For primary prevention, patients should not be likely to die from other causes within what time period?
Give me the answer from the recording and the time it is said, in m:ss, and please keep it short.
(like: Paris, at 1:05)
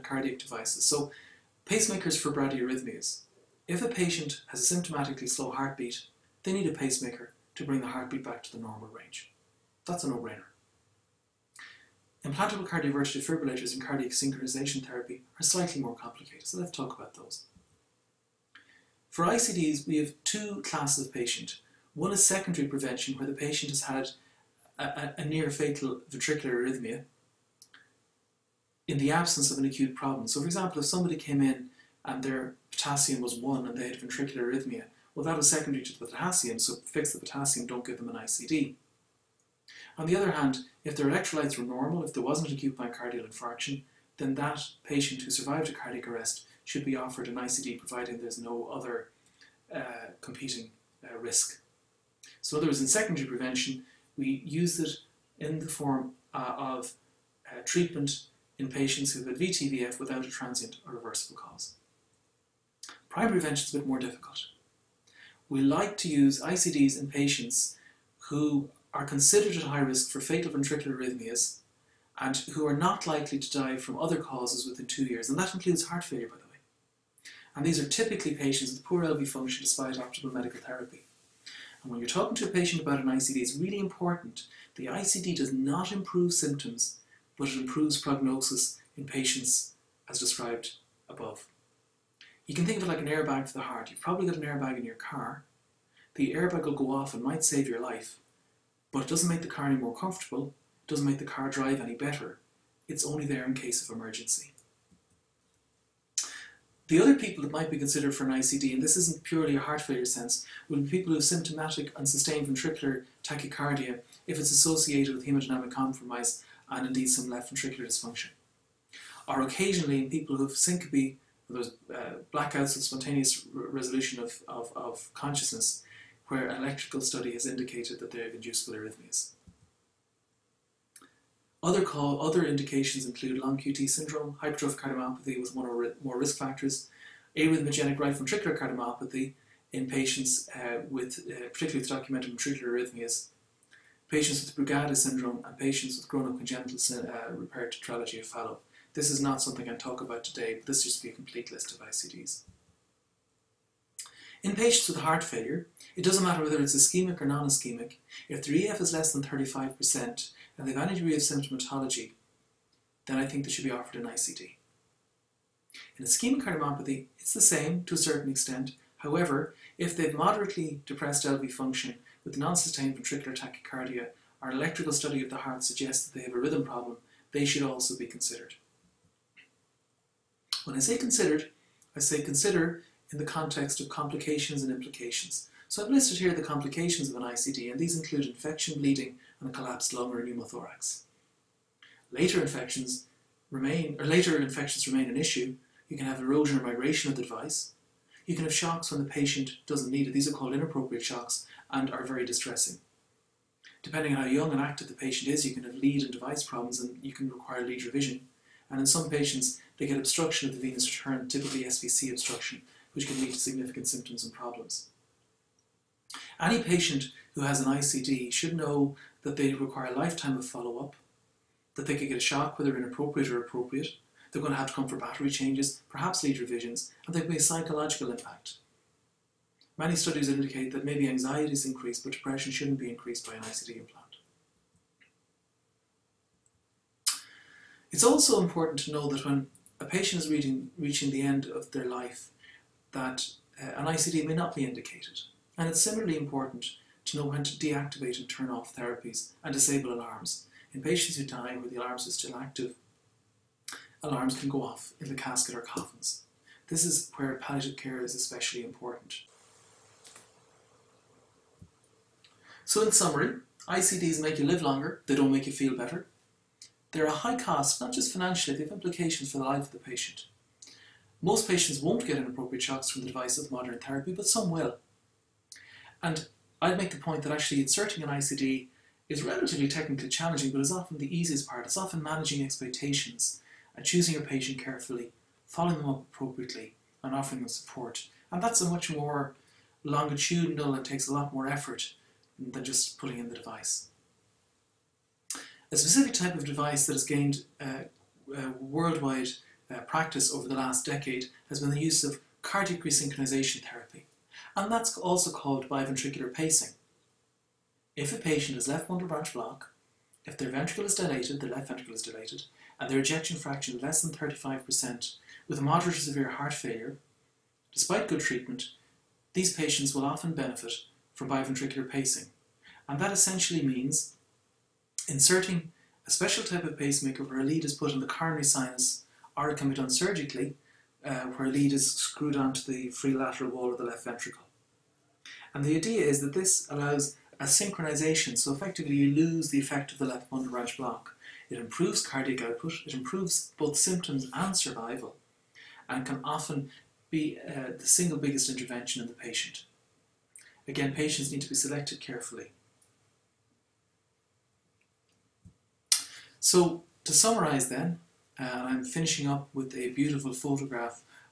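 Two years, at 1:14.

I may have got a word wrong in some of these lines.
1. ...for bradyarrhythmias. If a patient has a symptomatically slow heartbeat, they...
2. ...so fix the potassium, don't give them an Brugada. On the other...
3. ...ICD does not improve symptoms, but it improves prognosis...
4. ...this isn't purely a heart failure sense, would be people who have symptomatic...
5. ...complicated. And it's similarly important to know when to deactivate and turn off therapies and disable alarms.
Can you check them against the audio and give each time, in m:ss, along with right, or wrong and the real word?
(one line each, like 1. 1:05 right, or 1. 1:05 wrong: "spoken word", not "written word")
1. 0:02 right
2. 0:36 wrong: "ICD", not "Brugada"
3. 1:24 right
4. 1:48 right
5. 4:04 wrong: "indicated", not "complicated".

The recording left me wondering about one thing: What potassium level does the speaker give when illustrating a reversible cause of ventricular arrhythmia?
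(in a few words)
1.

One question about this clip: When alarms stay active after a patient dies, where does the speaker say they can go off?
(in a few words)
Casket or coffins.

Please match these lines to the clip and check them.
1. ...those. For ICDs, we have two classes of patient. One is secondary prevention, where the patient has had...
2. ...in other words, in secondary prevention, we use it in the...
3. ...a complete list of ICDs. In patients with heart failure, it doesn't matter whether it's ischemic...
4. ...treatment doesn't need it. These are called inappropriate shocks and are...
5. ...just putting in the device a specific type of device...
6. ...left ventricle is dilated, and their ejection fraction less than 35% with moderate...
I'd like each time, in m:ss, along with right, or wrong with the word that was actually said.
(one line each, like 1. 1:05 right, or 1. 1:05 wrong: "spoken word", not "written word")
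1. 0:17 right
2. 0:52 right
3. 2:31 right
4. 3:19 wrong: "patient", not "treatment"
5. 4:52 right
6. 5:11 right.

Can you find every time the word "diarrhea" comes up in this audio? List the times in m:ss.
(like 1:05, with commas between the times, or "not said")
not said.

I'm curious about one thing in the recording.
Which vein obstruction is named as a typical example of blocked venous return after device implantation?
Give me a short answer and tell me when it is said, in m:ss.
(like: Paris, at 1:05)
SVC, at 3:31.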